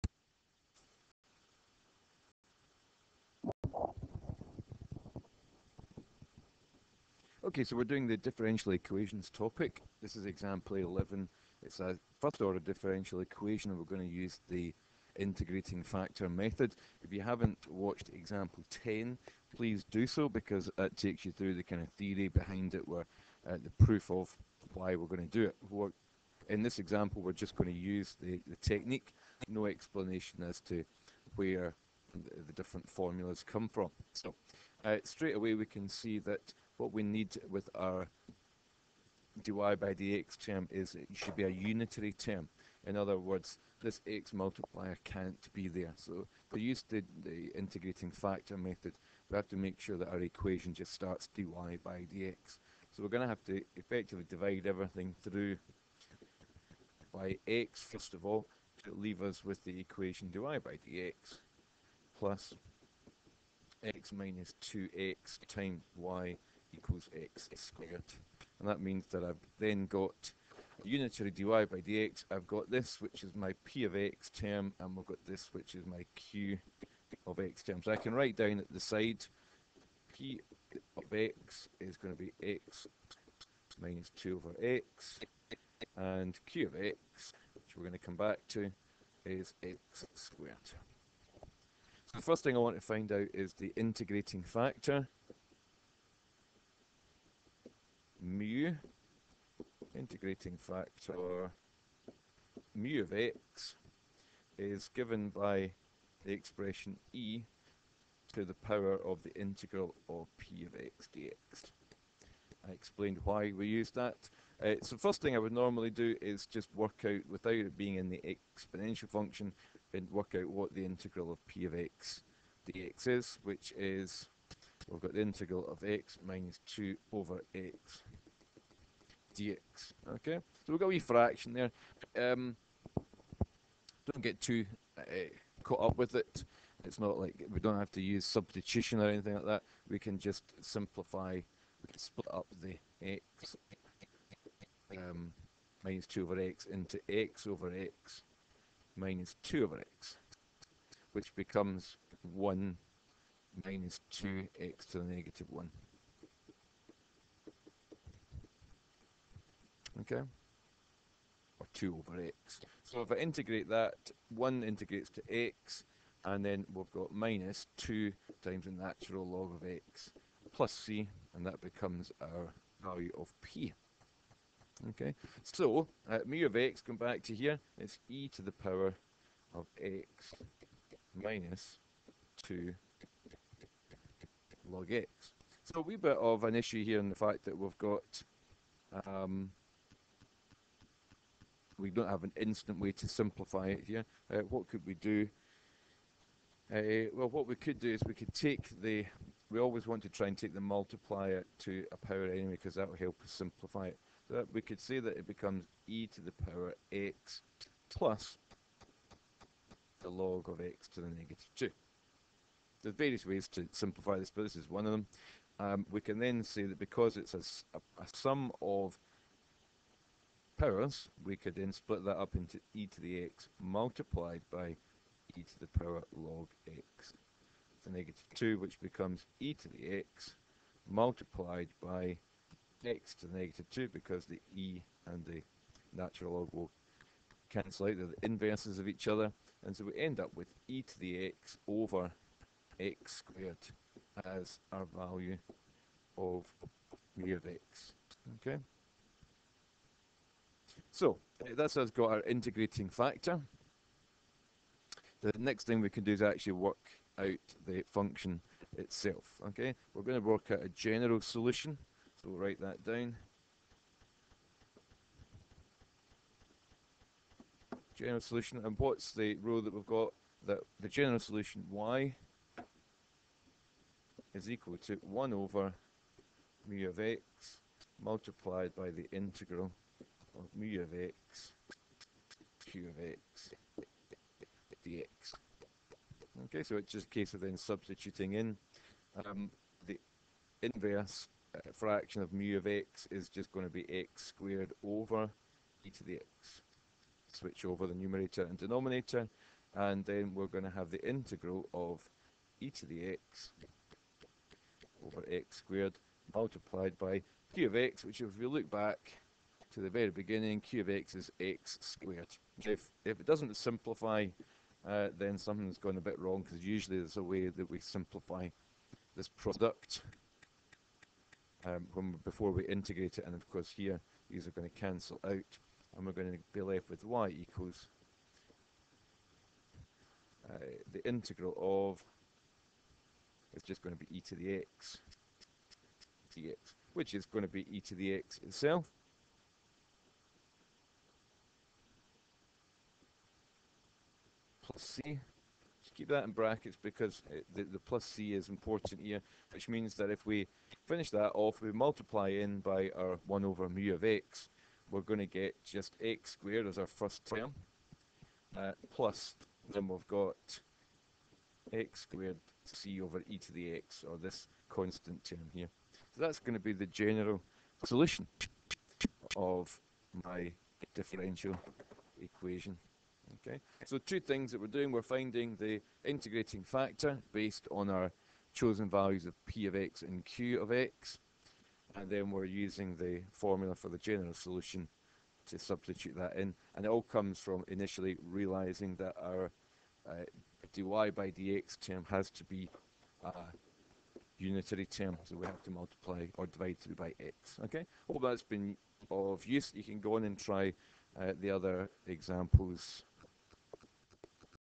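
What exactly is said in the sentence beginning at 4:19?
Okay, we're going to work out a general solution, so we'll write that down.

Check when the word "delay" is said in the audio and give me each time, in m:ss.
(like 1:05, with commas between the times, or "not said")
not said.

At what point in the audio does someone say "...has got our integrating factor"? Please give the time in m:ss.
4:11.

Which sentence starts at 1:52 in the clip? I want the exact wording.
I explained why we use that.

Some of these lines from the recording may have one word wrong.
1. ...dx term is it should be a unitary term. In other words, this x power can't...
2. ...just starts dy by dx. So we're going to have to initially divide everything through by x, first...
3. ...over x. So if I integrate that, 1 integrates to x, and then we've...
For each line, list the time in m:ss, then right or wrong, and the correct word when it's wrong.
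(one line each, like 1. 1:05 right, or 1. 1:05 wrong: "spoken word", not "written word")
1. 0:39 wrong: "multiplier", not "power"
2. 0:50 wrong: "effectively", not "initially"
3. 2:42 right.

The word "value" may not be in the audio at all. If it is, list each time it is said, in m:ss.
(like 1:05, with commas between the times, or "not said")
2:52, 4:04, 6:18.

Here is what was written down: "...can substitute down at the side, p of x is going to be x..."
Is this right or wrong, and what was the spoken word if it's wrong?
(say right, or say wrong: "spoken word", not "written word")
wrong: "write", not "substitute".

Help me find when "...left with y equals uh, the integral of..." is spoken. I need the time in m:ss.
5:26.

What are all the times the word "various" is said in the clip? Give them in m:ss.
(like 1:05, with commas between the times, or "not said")
3:32.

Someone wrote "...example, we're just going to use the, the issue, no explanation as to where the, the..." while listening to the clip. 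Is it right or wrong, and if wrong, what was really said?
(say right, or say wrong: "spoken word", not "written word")
wrong: "technique", not "issue".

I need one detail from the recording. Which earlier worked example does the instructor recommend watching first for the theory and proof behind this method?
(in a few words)
Example 10.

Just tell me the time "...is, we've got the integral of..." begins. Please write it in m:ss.
2:03.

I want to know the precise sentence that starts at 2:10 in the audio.
Okay, so we've got a wee fraction there.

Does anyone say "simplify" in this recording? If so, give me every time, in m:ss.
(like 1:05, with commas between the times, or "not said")
2:20, 3:13, 3:23, 3:33, 5:13, 5:17.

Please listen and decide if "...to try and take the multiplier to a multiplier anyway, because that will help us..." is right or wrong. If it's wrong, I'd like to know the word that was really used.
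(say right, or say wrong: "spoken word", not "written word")
wrong: "power", not "multiplier".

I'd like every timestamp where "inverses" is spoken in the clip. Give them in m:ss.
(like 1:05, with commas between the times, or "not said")
3:58, 4:50.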